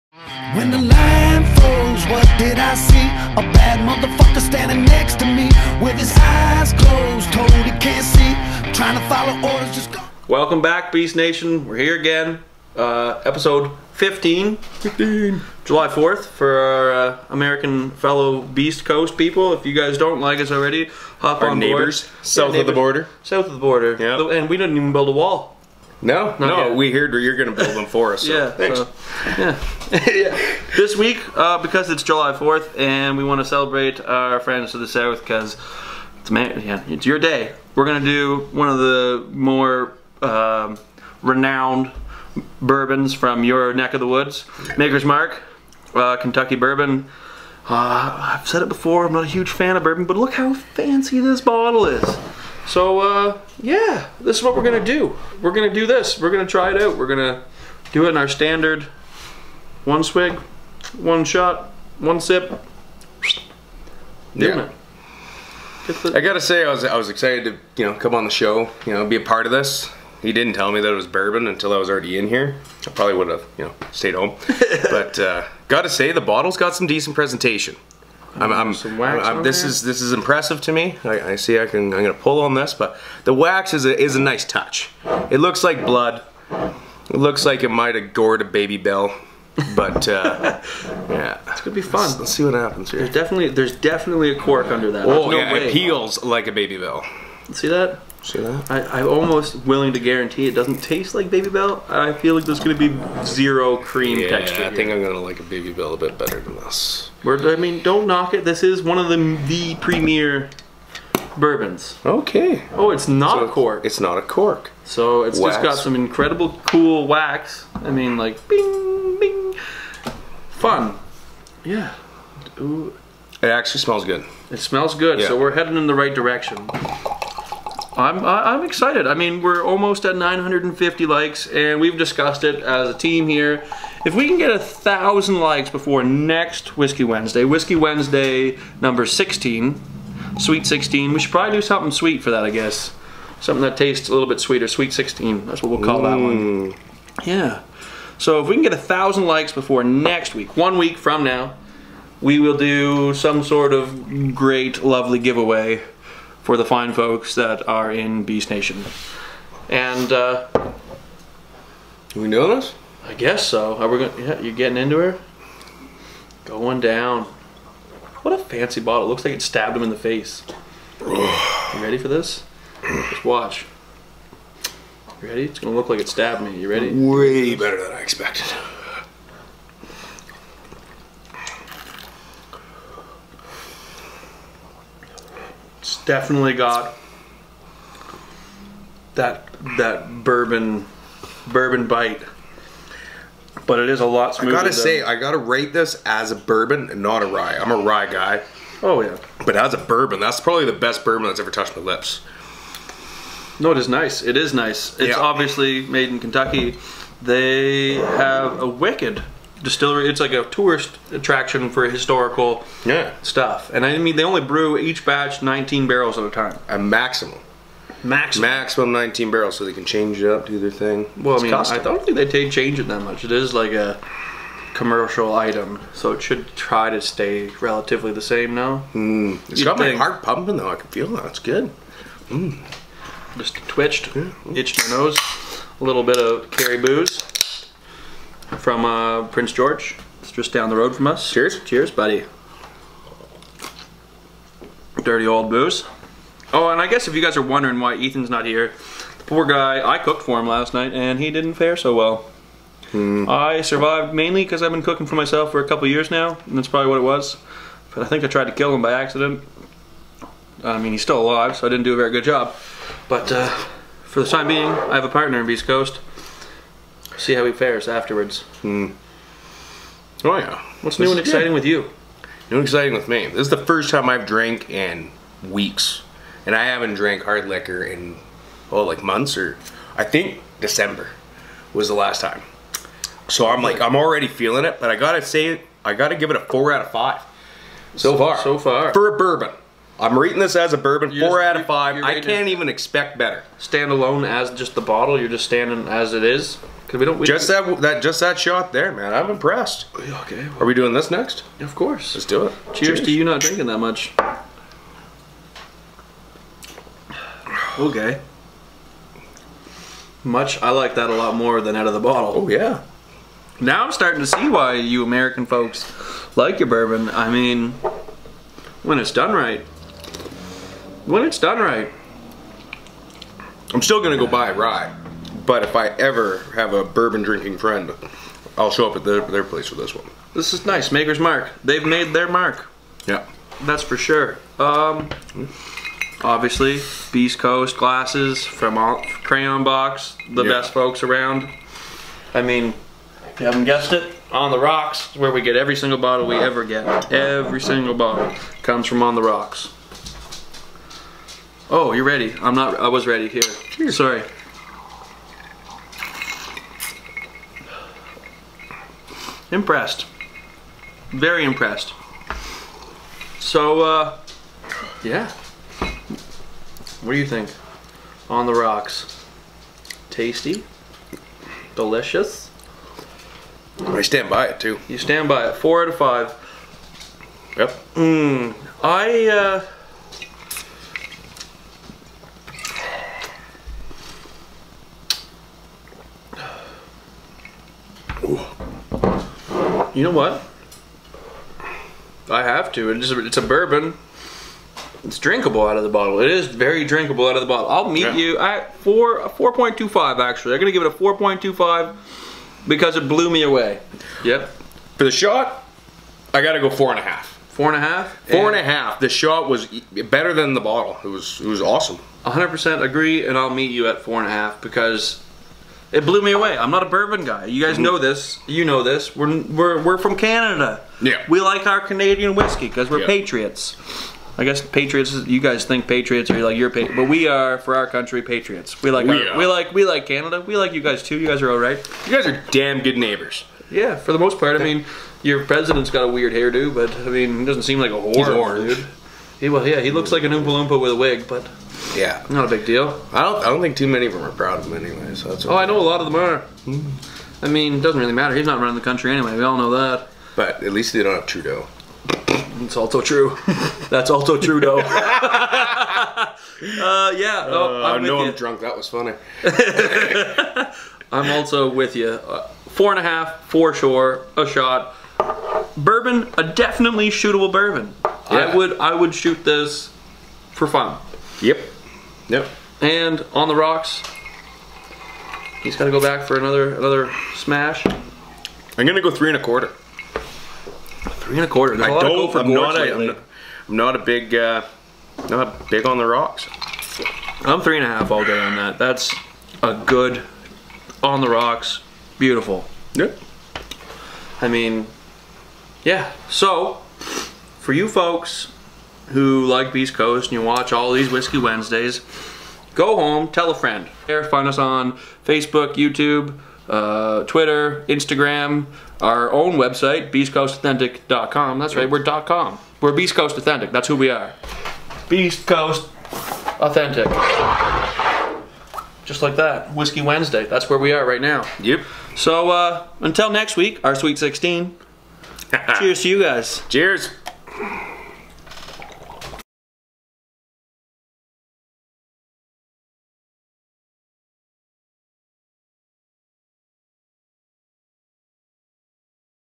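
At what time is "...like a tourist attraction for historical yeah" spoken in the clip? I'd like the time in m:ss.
3:30.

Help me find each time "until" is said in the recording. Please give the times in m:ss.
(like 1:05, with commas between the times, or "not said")
1:11, 8:43.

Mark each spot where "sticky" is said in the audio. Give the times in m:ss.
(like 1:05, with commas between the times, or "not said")
not said.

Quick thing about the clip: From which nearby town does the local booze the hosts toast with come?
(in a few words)
Prince George.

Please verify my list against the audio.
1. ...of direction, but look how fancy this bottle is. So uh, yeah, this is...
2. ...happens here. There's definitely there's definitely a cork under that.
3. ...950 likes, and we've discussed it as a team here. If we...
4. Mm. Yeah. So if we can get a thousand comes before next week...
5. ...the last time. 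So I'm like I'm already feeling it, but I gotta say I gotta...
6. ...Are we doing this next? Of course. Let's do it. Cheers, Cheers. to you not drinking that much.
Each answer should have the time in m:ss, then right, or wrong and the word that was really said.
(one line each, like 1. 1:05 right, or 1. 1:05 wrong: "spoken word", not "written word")
1. 0:49 wrong: "bourbon", not "direction"
2. 1:32 right
3. 2:10 right
4. 2:26 wrong: "likes", not "comes"
5. 4:41 right
6. 5:00 right.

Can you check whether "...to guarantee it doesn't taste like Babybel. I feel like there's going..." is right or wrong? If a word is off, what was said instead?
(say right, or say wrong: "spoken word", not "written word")
right.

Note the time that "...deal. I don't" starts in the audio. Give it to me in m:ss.
7:22.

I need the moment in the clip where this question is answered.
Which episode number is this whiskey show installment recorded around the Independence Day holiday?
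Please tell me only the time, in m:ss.
0:13.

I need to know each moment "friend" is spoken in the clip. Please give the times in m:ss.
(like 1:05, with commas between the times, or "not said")
0:34, 5:27, 8:23.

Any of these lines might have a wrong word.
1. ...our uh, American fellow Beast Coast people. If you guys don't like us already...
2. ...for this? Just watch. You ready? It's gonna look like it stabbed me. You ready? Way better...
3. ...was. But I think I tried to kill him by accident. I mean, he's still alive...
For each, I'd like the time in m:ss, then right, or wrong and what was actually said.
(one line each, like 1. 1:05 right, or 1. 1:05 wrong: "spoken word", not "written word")
1. 0:16 right
2. 2:51 right
3. 4:17 right.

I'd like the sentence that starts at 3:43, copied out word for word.
It is like a commercial item, so it should try to stay relatively the same now.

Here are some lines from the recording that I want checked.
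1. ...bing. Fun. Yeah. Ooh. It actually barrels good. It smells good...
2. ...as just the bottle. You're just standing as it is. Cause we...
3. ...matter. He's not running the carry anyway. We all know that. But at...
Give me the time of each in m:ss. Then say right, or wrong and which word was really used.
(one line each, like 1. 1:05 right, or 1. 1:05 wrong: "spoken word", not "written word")
1. 1:59 wrong: "smells", not "barrels"
2. 4:54 right
3. 7:28 wrong: "country", not "carry".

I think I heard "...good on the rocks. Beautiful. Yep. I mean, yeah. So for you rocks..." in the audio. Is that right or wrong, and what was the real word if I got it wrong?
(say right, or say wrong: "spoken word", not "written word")
wrong: "folks", not "rocks".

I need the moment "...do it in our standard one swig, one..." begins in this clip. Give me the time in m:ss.
0:57.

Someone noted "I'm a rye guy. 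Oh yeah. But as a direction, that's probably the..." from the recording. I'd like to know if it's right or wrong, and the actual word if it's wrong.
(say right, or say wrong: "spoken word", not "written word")
wrong: "bourbon", not "direction".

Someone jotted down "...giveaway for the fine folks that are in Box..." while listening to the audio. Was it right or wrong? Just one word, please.
wrong.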